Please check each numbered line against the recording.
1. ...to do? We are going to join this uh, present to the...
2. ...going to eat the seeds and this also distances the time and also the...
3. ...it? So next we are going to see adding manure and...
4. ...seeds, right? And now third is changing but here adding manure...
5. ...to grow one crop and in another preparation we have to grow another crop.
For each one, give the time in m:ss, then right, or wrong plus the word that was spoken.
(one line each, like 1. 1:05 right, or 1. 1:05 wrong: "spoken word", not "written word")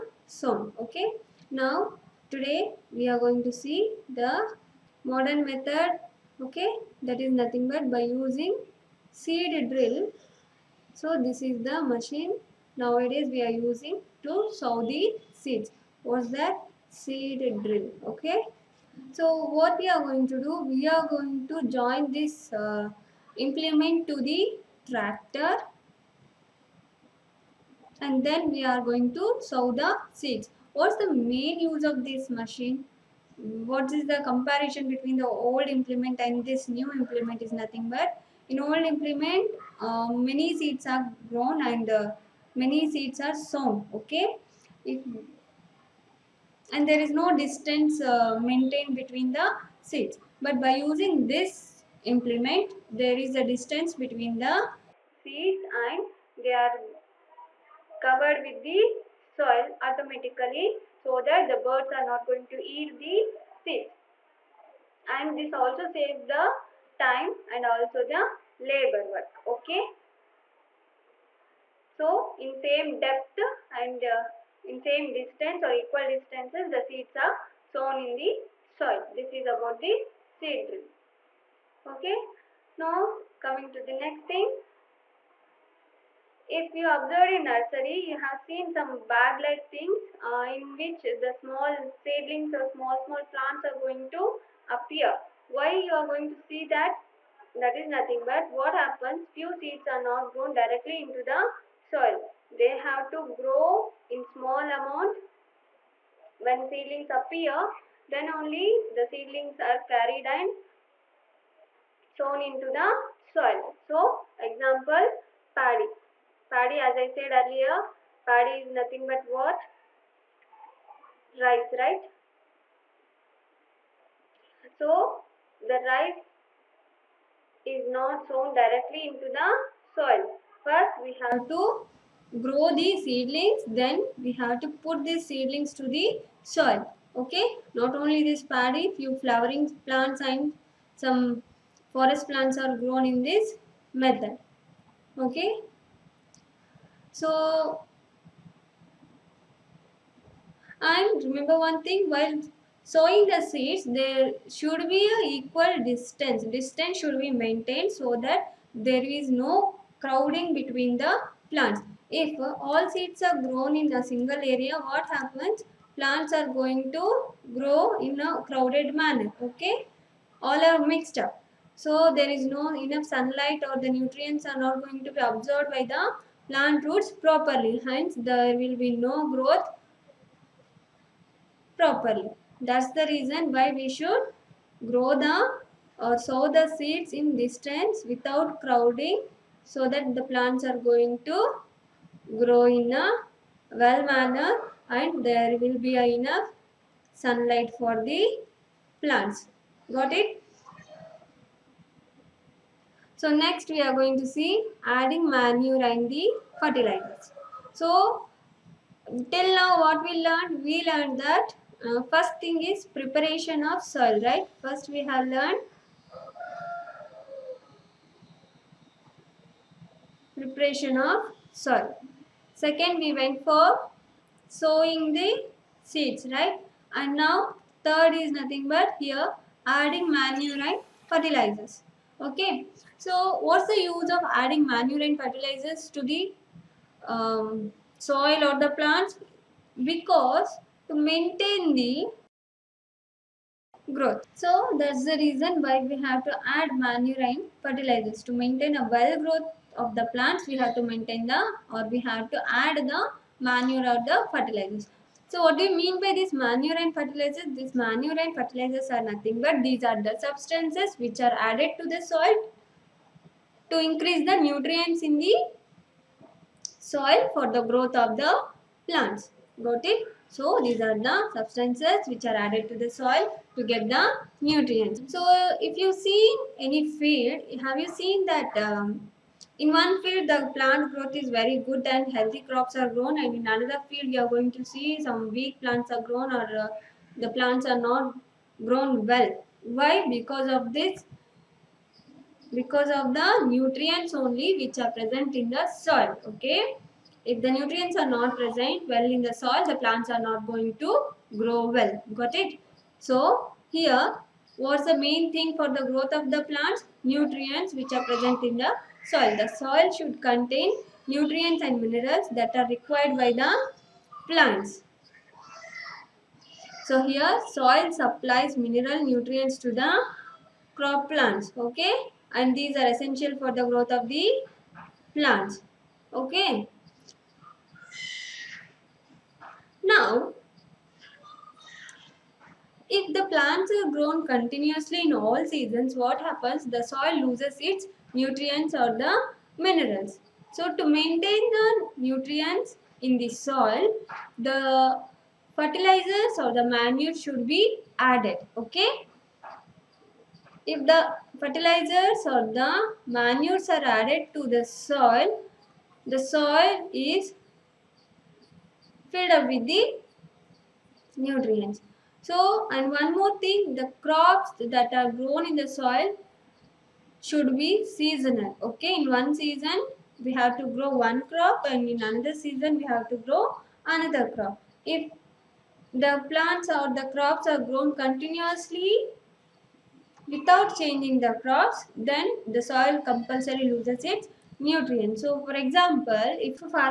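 1. 0:20 wrong: "implement", not "present"
2. 1:02 wrong: "saves", not "distances"
3. 3:20 right
4. 3:45 wrong: "nothing", not "changing"
5. 6:10 wrong: "season", not "preparation".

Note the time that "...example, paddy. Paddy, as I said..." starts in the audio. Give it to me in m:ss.
1:54.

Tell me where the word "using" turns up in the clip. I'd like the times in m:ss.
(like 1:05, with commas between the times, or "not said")
0:08, 0:13, 0:50.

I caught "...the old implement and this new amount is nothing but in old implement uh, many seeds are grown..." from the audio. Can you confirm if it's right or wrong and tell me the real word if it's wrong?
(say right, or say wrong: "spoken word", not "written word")
wrong: "implement", not "amount".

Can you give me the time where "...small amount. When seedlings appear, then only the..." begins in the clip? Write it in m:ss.
1:44.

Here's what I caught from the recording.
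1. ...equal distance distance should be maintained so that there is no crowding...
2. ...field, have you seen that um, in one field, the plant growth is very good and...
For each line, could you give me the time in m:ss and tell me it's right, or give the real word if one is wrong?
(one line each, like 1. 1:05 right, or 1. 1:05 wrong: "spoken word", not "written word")
1. 2:35 right
2. 4:36 right.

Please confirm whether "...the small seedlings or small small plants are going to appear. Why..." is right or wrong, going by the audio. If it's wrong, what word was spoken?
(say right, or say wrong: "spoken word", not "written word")
right.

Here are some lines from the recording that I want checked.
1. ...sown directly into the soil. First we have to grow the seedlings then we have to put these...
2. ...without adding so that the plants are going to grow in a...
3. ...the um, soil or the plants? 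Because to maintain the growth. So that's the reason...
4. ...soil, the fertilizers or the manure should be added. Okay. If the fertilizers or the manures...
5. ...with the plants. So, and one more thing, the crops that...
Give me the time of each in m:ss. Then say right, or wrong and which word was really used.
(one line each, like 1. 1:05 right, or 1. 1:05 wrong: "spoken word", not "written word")
1. 2:08 right
2. 3:08 wrong: "crowding", not "adding"
3. 3:56 right
4. 5:43 right
5. 5:59 wrong: "nutrients", not "plants".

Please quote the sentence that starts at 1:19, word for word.
This is about the seed drill.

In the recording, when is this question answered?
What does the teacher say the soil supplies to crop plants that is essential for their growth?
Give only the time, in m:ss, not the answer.
5:18.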